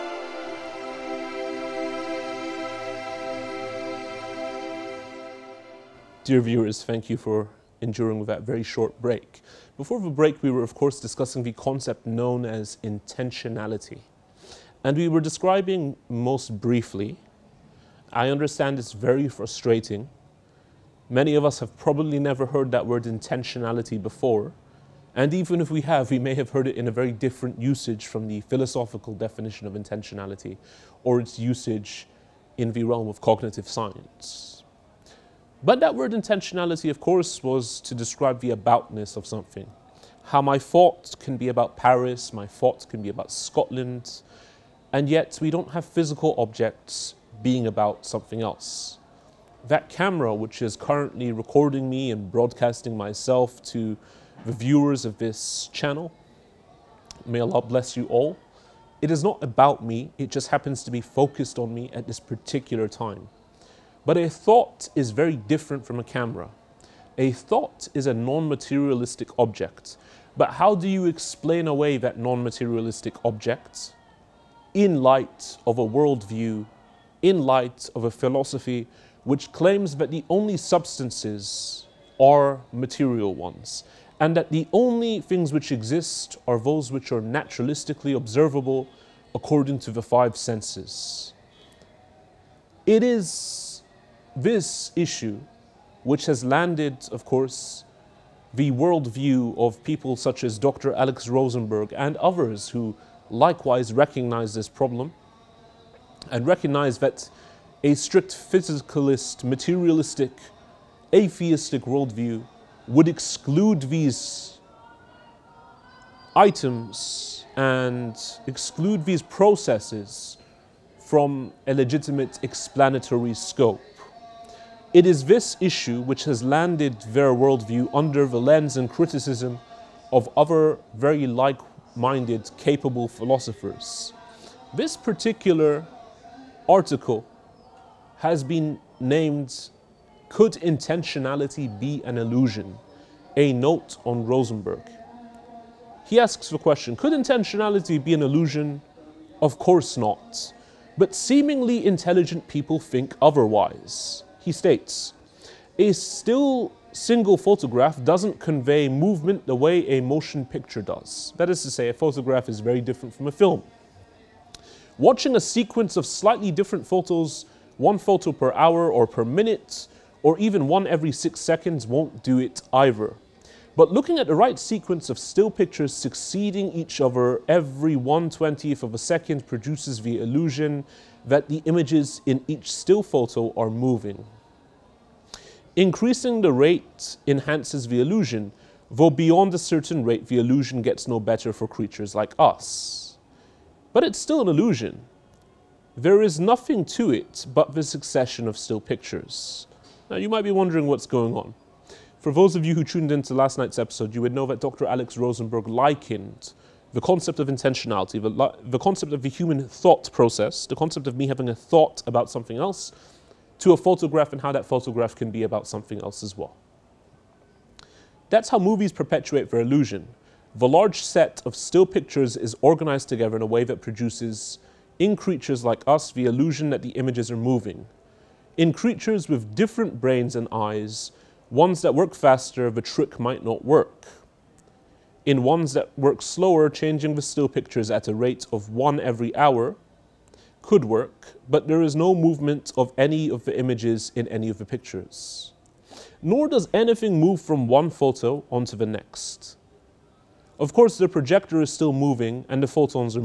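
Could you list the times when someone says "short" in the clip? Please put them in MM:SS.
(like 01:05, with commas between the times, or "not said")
00:08.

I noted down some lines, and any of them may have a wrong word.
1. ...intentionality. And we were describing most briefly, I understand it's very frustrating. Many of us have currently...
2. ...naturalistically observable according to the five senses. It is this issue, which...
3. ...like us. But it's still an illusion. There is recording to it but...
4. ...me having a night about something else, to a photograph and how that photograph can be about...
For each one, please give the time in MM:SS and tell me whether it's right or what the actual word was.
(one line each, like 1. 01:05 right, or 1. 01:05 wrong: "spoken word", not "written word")
1. 00:12 wrong: "probably", not "currently"
2. 01:27 right
3. 03:12 wrong: "nothing", not "recording"
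4. 03:31 wrong: "thought", not "night".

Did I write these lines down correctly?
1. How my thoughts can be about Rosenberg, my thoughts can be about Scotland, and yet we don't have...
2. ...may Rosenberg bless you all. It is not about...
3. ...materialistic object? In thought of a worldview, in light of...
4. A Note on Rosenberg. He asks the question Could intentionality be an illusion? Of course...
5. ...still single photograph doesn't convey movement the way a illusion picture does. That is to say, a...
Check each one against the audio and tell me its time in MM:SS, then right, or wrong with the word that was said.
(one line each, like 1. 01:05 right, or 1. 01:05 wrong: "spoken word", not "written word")
1. 00:40 wrong: "Paris", not "Rosenberg"
2. 00:57 wrong: "Allah", not "Rosenberg"
3. 01:12 wrong: "light", not "thought"
4. 02:23 right
5. 02:35 wrong: "motion", not "illusion".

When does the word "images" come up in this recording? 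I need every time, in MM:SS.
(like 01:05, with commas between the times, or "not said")
03:01, 03:46, 04:03.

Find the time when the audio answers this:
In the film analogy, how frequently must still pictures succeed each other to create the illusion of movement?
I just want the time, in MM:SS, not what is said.
02:57.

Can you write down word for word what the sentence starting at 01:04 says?
But a thought is very different from a camera.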